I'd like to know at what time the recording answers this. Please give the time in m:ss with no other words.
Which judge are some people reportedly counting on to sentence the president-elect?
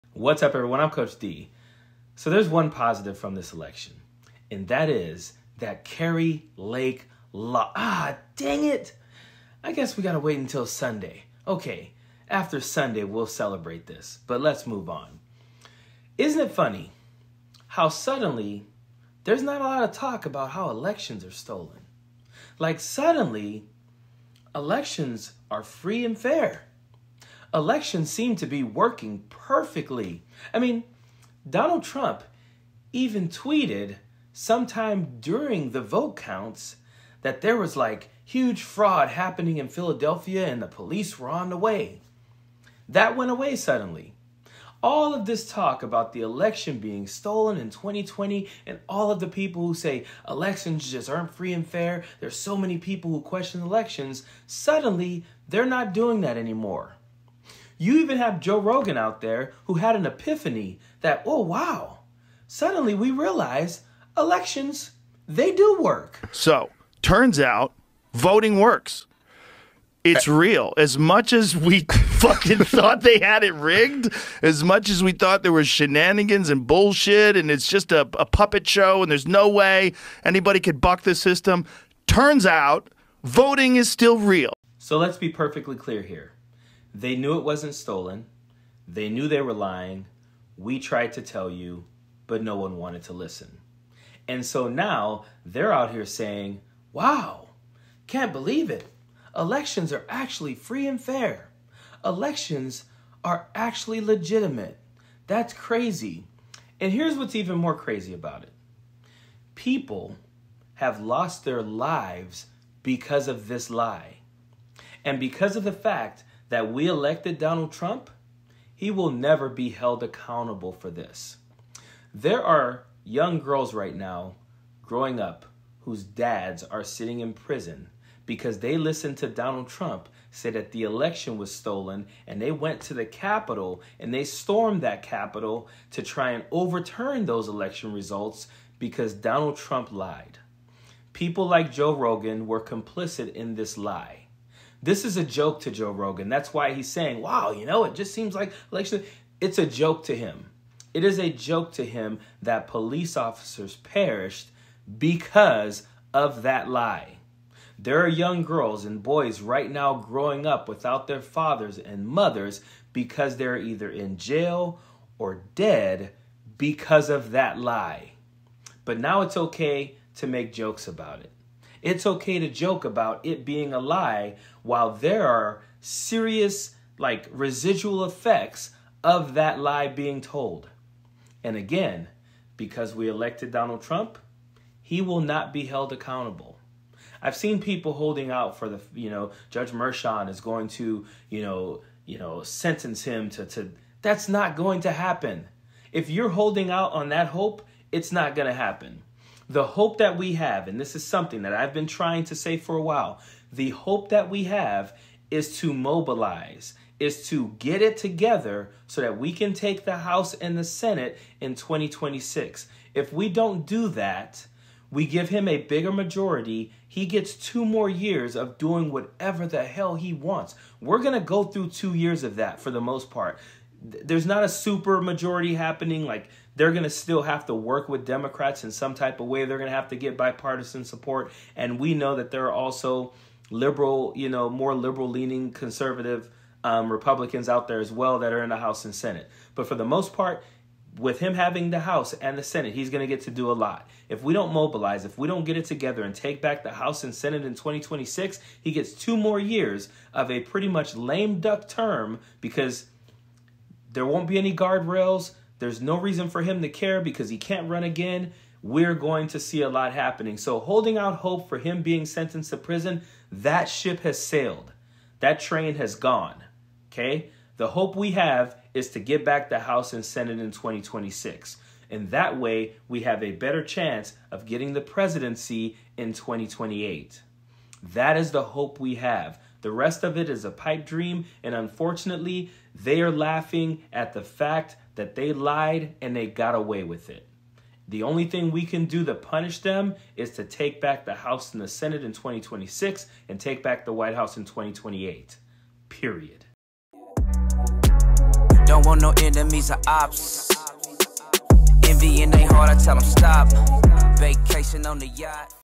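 3:09.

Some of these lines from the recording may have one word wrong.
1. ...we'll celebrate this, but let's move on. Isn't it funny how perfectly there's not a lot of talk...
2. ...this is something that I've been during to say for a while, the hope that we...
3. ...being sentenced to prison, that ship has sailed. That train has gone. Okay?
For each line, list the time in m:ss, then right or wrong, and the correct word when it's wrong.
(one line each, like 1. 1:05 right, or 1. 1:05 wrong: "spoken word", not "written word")
1. 0:13 wrong: "suddenly", not "perfectly"
2. 3:20 wrong: "trying", not "during"
3. 4:21 right.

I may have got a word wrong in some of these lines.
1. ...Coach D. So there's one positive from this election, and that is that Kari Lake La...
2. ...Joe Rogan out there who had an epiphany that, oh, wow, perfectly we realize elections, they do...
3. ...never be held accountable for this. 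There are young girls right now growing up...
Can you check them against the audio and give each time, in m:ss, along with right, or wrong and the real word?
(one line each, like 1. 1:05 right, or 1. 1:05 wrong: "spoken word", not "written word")
1. 0:00 right
2. 0:58 wrong: "suddenly", not "perfectly"
3. 1:59 right.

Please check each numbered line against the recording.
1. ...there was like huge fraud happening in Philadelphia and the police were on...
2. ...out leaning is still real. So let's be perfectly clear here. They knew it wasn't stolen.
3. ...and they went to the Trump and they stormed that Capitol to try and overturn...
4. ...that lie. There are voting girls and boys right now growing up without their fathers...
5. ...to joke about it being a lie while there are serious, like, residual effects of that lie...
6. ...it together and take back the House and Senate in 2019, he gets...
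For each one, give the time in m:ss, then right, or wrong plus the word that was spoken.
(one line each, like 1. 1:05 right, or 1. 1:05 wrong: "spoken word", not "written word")
1. 0:37 right
2. 1:22 wrong: "voting", not "leaning"
3. 2:12 wrong: "Capitol", not "Trump"
4. 2:36 wrong: "young", not "voting"
5. 2:52 right
6. 4:05 wrong: "2026", not "2019".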